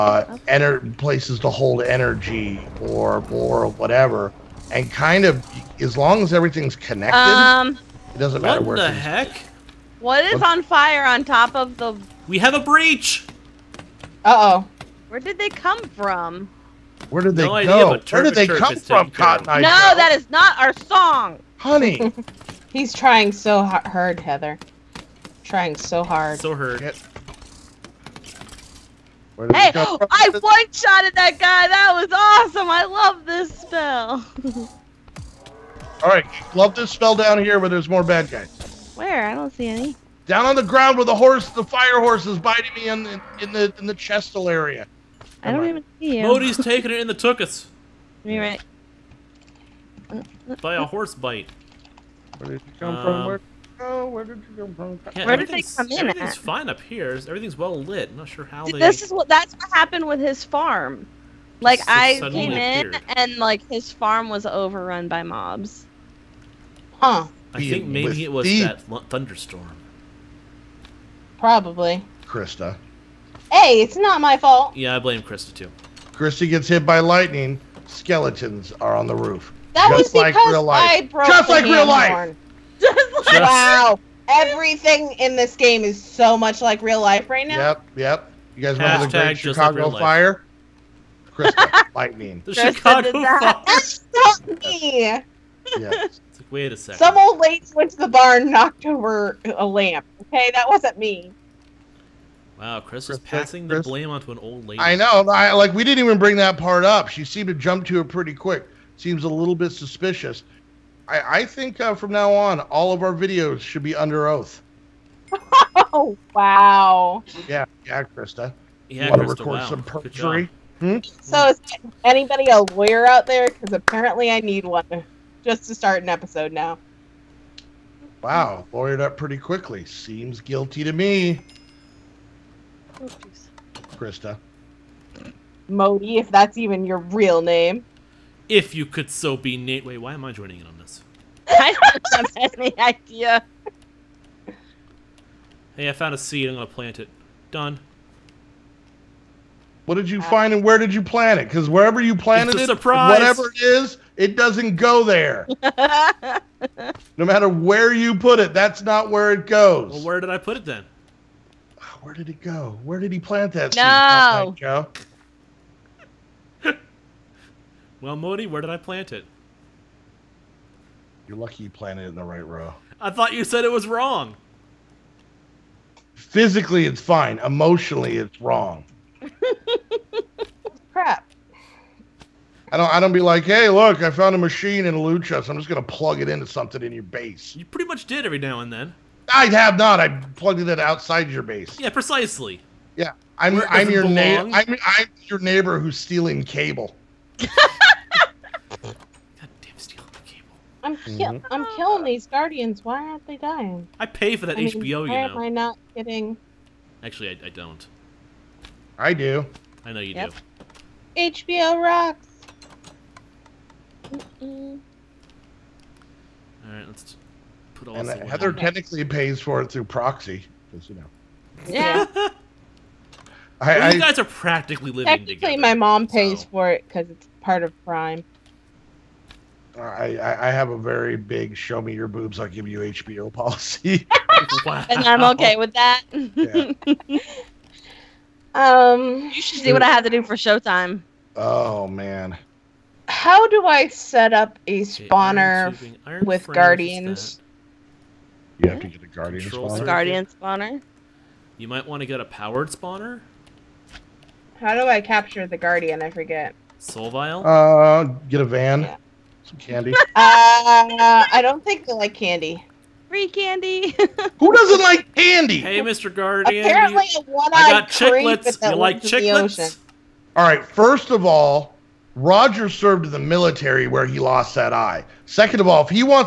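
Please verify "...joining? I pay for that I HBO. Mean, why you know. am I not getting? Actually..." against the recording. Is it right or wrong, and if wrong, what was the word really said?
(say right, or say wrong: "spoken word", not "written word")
wrong: "dying", not "joining".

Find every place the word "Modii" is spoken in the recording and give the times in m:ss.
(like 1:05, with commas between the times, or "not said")
0:46, 2:15, 2:48.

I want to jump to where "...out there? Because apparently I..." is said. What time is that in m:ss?
2:03.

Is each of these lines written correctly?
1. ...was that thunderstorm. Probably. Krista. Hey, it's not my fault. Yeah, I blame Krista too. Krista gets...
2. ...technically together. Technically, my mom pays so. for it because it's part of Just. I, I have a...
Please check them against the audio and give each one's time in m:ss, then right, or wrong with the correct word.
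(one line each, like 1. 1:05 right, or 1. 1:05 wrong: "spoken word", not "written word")
1. 1:08 right
2. 3:45 wrong: "Prime", not "Just".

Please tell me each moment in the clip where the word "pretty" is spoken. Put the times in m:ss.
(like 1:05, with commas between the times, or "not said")
1:48, 2:09, 3:07.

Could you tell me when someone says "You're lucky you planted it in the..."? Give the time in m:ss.
2:51.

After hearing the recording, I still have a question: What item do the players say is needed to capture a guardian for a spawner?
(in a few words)
Soul vial.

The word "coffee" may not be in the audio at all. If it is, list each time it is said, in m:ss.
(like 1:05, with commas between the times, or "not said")
not said.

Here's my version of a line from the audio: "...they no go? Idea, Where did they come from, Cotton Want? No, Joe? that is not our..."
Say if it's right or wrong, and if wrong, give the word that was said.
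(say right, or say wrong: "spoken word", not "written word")
wrong: "Eye", not "Want".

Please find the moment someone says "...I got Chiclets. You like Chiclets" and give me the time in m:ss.
4:27.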